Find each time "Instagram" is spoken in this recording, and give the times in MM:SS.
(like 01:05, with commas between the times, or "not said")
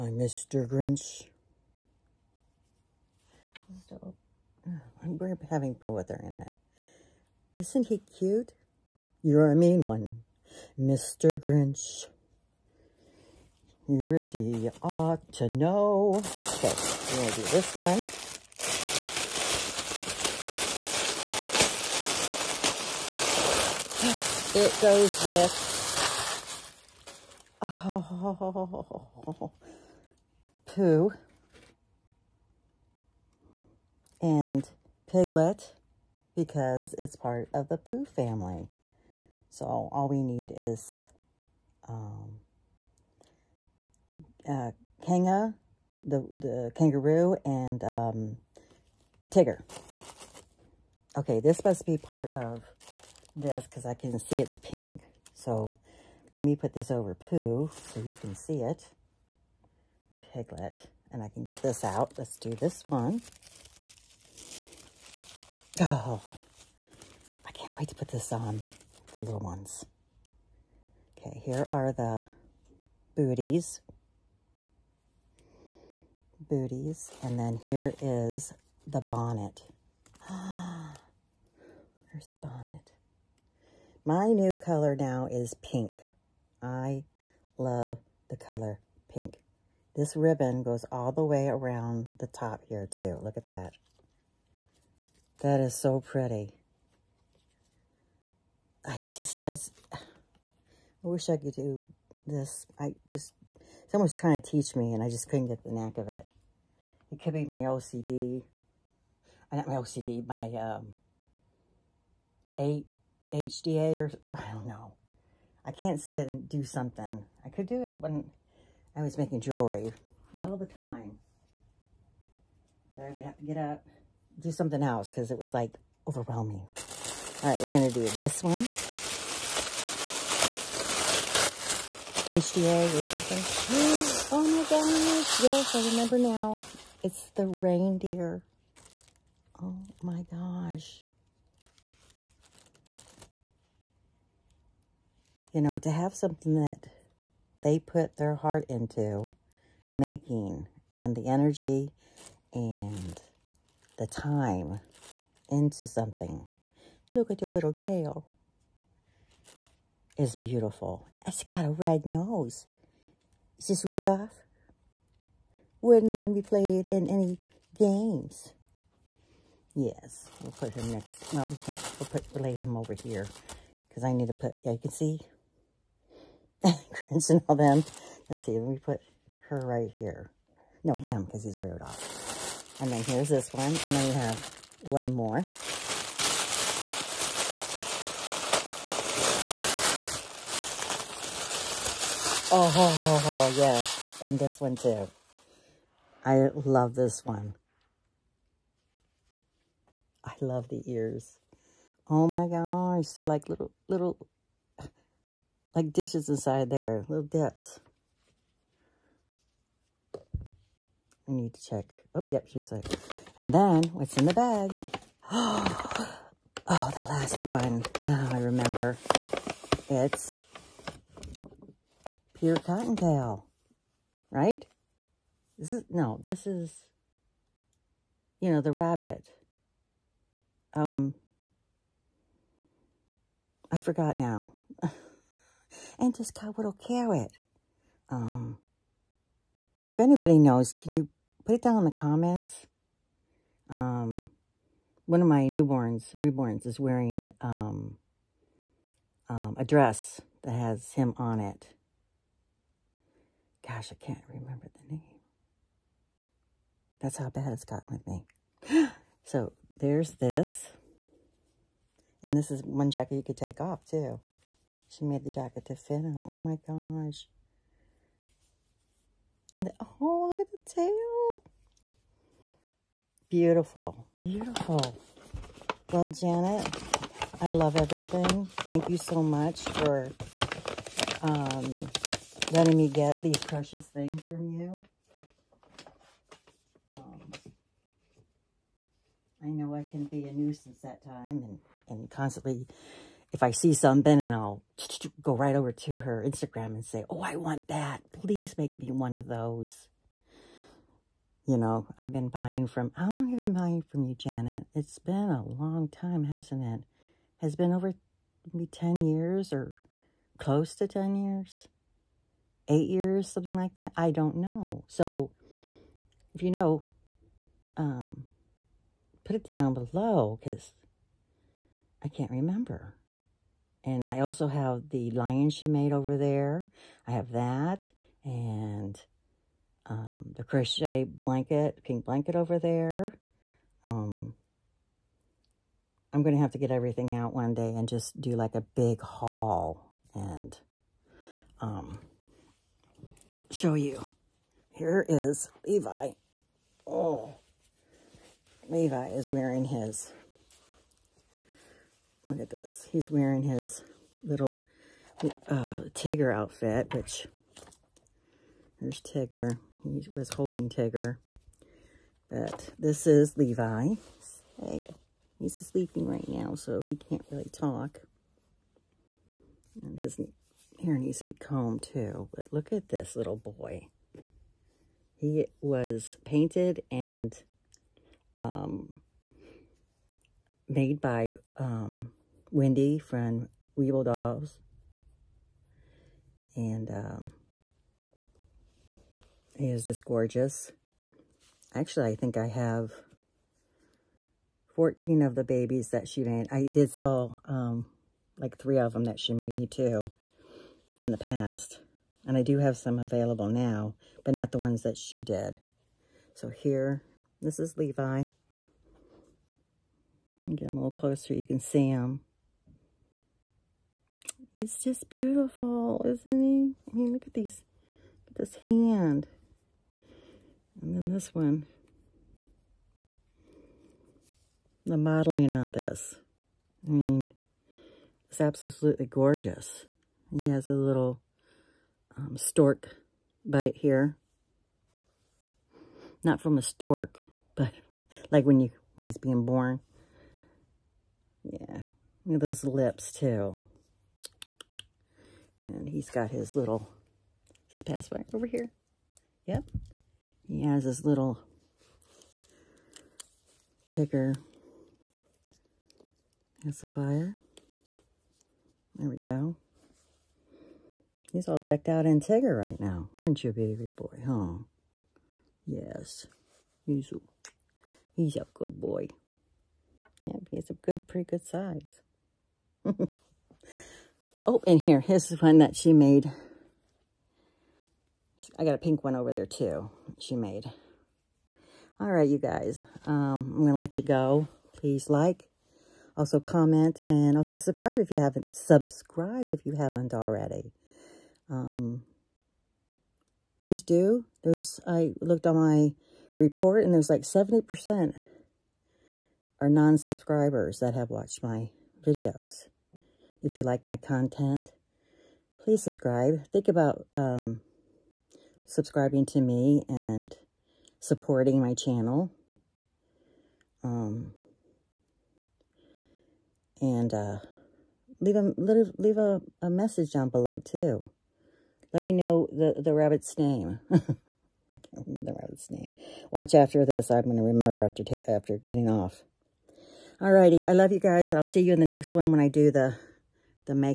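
04:56.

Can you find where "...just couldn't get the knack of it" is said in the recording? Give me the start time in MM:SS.
01:45.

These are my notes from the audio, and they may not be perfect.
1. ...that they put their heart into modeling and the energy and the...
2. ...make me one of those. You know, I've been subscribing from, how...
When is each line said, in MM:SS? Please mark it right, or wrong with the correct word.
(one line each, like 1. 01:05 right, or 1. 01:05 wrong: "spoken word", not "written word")
1. 02:26 wrong: "making", not "modeling"
2. 04:58 wrong: "buying", not "subscribing".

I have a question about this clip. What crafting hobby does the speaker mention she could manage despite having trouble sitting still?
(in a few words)
Making jewelry.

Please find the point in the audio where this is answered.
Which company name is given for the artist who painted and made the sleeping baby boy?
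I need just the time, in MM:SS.
06:23.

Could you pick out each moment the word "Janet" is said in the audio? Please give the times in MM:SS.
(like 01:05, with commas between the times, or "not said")
04:36, 05:04.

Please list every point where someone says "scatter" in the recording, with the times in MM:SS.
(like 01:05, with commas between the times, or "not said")
not said.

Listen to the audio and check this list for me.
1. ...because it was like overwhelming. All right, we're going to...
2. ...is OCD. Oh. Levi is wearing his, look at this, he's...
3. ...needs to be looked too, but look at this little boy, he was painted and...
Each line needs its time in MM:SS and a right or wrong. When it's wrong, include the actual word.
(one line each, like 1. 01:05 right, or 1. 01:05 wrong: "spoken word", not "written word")
1. 02:05 right
2. 05:45 wrong: "Levi", not "OCD"
3. 06:10 wrong: "combed", not "looked".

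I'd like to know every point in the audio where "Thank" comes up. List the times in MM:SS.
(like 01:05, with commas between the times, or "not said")
04:38.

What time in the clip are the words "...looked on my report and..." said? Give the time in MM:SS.
08:15.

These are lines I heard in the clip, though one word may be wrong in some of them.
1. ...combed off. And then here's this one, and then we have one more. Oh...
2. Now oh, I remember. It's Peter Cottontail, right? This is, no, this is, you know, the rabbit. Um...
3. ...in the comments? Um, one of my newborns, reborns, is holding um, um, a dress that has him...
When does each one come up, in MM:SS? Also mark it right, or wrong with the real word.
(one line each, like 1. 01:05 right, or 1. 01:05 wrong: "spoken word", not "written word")
1. 03:01 wrong: "reared", not "combed"
2. 03:38 right
3. 04:01 wrong: "wearing", not "holding".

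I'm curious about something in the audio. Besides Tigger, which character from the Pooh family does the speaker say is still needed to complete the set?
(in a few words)
Kanga.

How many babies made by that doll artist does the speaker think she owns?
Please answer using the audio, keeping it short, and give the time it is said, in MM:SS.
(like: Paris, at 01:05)
14, at 06:34.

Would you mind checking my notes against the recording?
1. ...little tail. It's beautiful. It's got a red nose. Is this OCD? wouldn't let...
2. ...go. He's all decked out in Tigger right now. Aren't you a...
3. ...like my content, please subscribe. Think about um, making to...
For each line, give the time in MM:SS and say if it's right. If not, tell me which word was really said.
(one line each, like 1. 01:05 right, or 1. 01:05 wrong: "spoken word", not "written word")
1. 02:37 wrong: "Rudolph", not "OCD"
2. 07:39 right
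3. 08:23 wrong: "subscribing", not "making".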